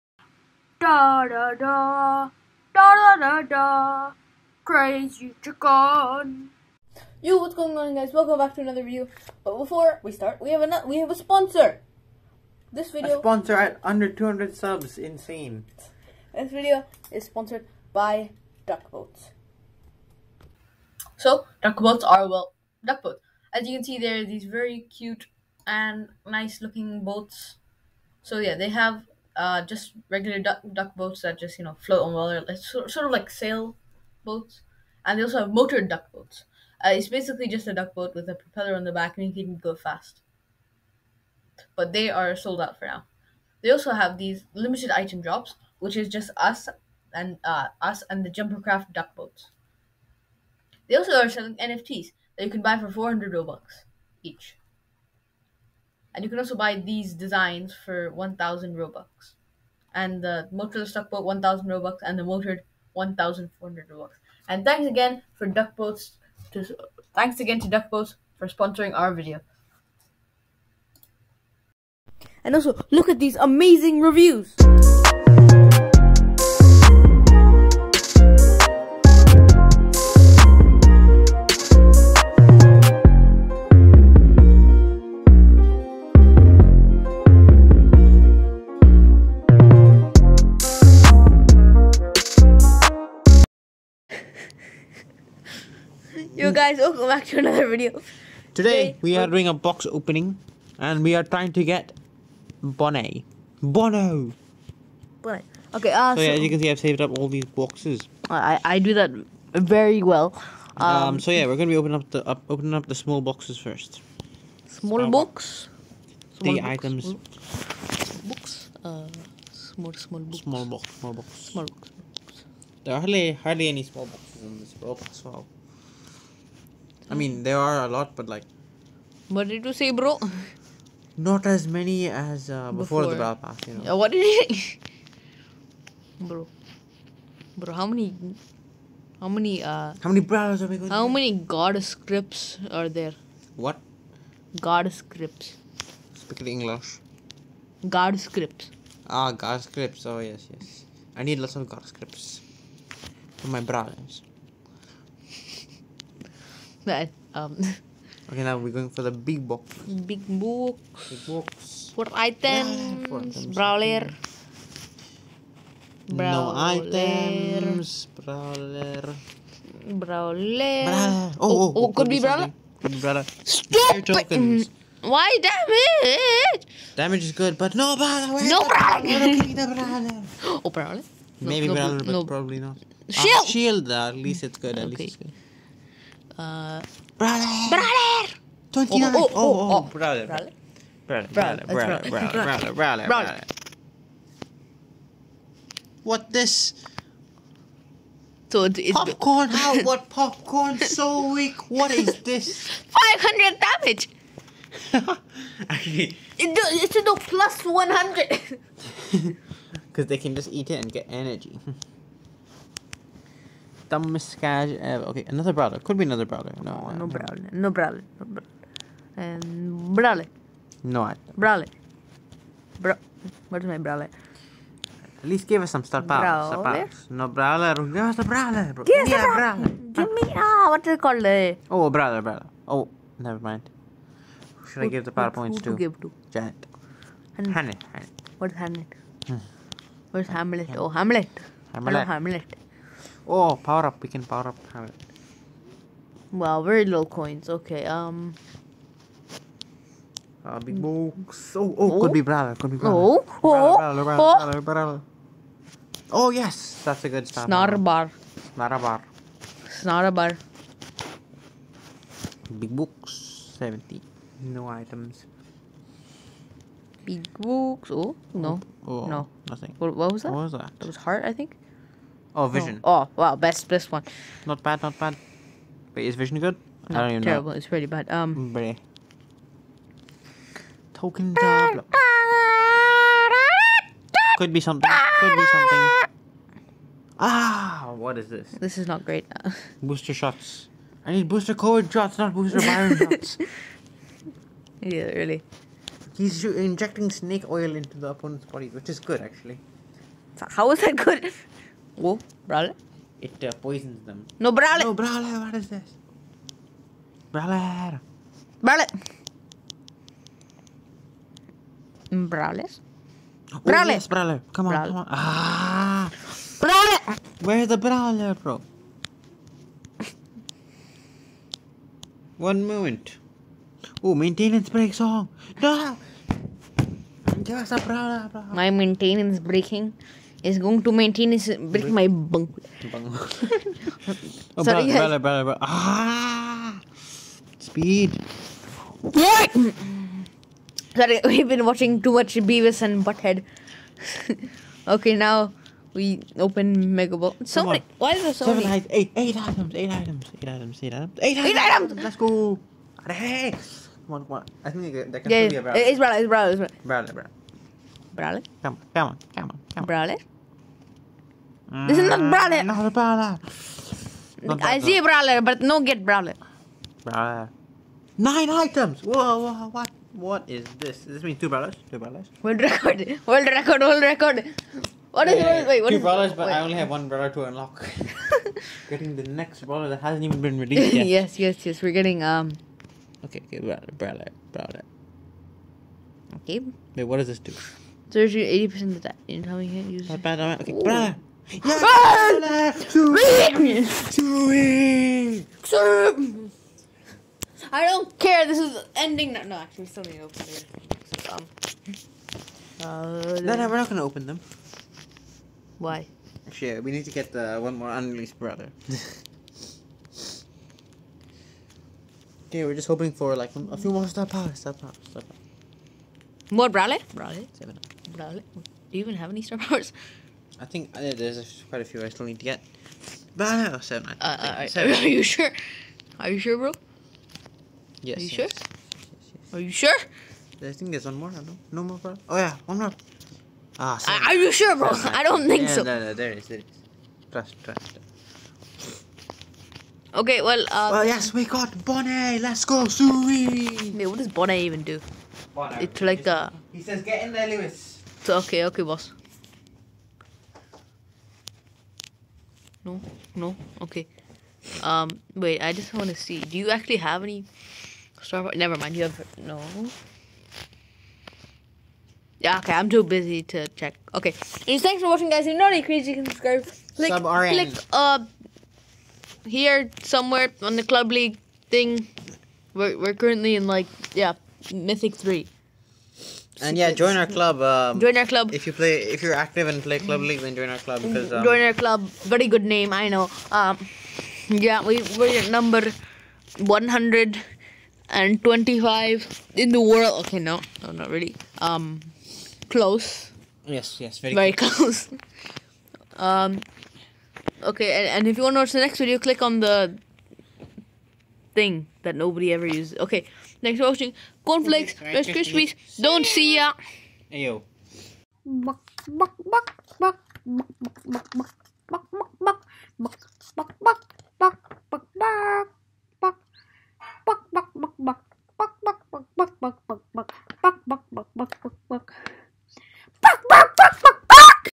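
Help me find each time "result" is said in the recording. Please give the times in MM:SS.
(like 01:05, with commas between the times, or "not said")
not said.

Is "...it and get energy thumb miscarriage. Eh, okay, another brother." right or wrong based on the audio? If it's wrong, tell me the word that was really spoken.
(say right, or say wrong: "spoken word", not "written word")
right.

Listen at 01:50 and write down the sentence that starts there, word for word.
Um, um so yeah, we're going to be opening up the up, opening up the small boxes first.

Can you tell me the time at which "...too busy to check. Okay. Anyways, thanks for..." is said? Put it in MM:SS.
07:42.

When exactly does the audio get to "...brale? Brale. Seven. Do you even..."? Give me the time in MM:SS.
06:56.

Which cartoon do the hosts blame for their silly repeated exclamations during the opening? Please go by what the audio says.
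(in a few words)
Beavis and Butthead.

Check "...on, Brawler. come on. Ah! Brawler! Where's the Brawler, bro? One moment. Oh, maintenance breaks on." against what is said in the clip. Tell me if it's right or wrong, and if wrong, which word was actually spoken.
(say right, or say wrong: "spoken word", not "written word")
right.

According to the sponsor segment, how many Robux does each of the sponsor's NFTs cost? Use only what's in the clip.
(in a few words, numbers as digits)
400.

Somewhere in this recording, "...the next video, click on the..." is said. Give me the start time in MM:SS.
08:18.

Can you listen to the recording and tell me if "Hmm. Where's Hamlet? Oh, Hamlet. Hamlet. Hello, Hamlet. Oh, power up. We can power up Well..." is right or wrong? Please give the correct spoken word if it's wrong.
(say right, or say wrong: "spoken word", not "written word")
right.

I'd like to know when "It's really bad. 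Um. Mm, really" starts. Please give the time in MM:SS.
04:37.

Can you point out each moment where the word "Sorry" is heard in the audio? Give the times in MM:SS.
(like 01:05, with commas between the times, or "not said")
05:34, 05:40.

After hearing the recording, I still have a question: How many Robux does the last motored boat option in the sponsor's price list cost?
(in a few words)
1400.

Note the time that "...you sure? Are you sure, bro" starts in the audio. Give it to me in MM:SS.
07:05.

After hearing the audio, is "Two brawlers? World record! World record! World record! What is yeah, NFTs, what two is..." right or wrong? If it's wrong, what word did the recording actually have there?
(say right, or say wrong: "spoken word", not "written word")
wrong: "Wait", not "NFTs".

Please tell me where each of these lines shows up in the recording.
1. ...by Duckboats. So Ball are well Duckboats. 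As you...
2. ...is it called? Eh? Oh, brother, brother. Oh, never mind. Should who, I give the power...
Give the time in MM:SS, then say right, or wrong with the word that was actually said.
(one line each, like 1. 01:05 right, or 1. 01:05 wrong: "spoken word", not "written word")
1. 00:17 wrong: "Duckboats", not "Ball"
2. 03:50 right.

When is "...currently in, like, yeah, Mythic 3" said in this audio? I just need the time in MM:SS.
07:53.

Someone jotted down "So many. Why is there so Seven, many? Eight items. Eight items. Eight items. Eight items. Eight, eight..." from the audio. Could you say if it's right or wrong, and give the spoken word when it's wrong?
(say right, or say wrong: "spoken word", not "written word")
right.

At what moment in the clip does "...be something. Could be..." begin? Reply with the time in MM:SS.
04:44.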